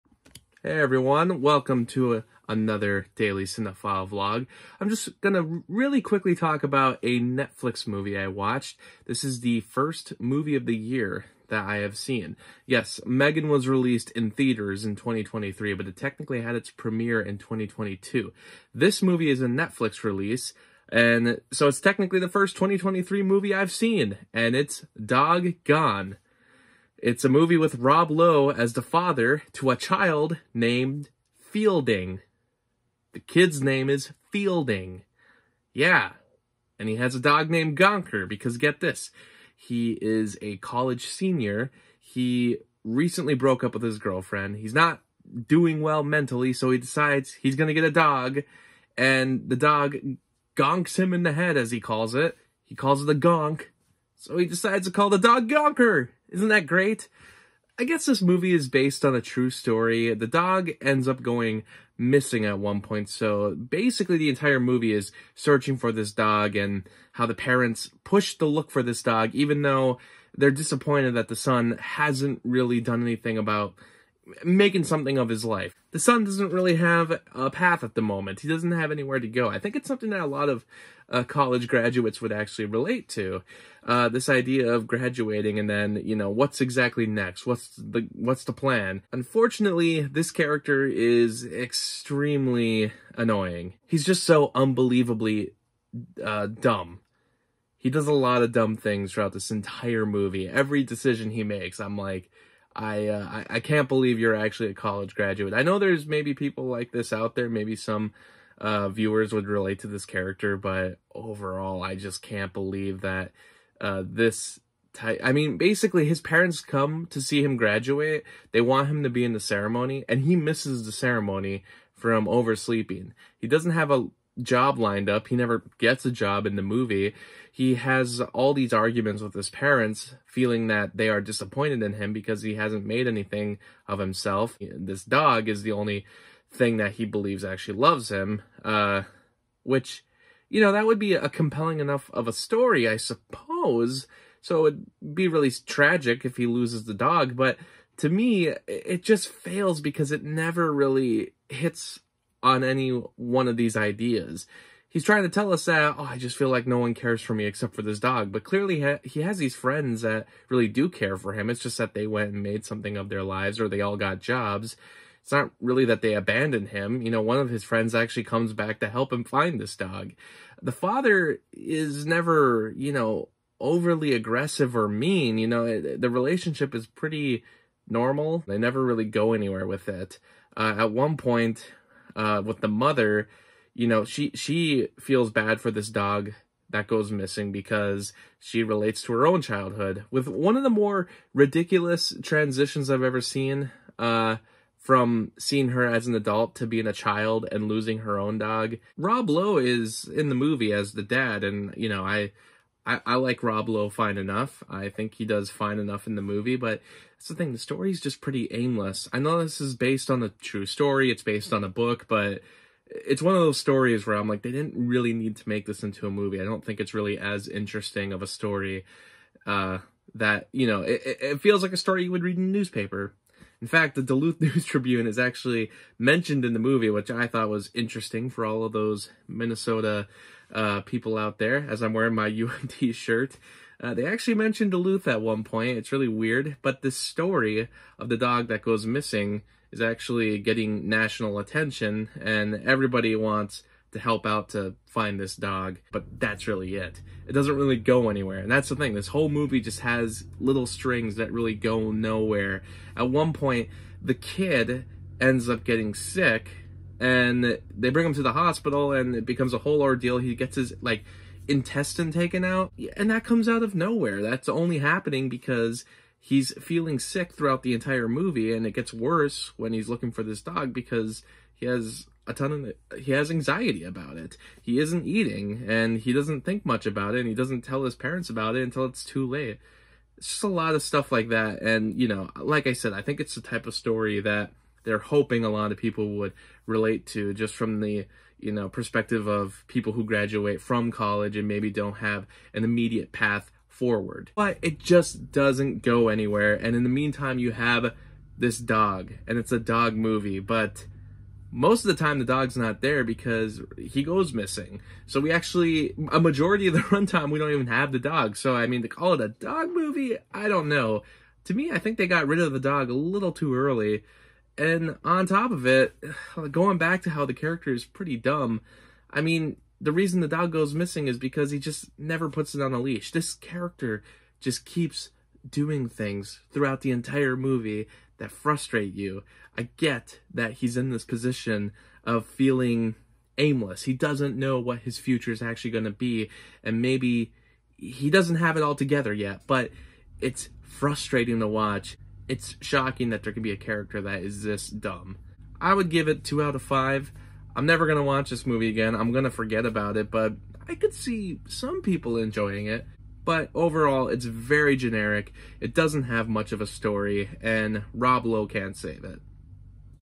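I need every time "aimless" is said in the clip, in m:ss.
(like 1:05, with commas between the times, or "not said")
3:28, 5:33.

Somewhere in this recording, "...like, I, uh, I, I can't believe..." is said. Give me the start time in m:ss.
1:41.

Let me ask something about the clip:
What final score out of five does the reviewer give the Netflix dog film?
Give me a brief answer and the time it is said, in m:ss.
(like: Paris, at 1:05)
2, at 5:46.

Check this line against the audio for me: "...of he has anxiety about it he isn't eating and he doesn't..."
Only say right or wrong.
right.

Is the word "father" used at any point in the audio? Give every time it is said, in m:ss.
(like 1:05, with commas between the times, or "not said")
0:28, 2:50.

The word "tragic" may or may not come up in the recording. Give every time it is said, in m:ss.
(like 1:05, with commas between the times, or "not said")
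2:25.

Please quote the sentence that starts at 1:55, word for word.
I mean, basically, his parents come to see him graduate.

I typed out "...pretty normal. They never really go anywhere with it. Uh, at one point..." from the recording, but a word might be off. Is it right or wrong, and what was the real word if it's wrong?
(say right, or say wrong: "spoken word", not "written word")
right.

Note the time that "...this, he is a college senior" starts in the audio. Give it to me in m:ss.
0:38.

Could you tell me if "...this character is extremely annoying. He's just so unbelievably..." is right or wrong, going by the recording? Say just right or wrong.
right.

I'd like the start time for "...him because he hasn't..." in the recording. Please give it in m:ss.
2:11.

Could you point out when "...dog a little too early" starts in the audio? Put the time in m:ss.
5:12.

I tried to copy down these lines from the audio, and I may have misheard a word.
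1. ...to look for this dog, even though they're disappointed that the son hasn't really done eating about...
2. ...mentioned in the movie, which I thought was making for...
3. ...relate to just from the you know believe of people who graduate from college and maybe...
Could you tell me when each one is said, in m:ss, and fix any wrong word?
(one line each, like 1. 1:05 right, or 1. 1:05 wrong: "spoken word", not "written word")
1. 1:08 wrong: "anything", not "eating"
2. 3:45 wrong: "interesting", not "making"
3. 4:46 wrong: "perspective", not "believe".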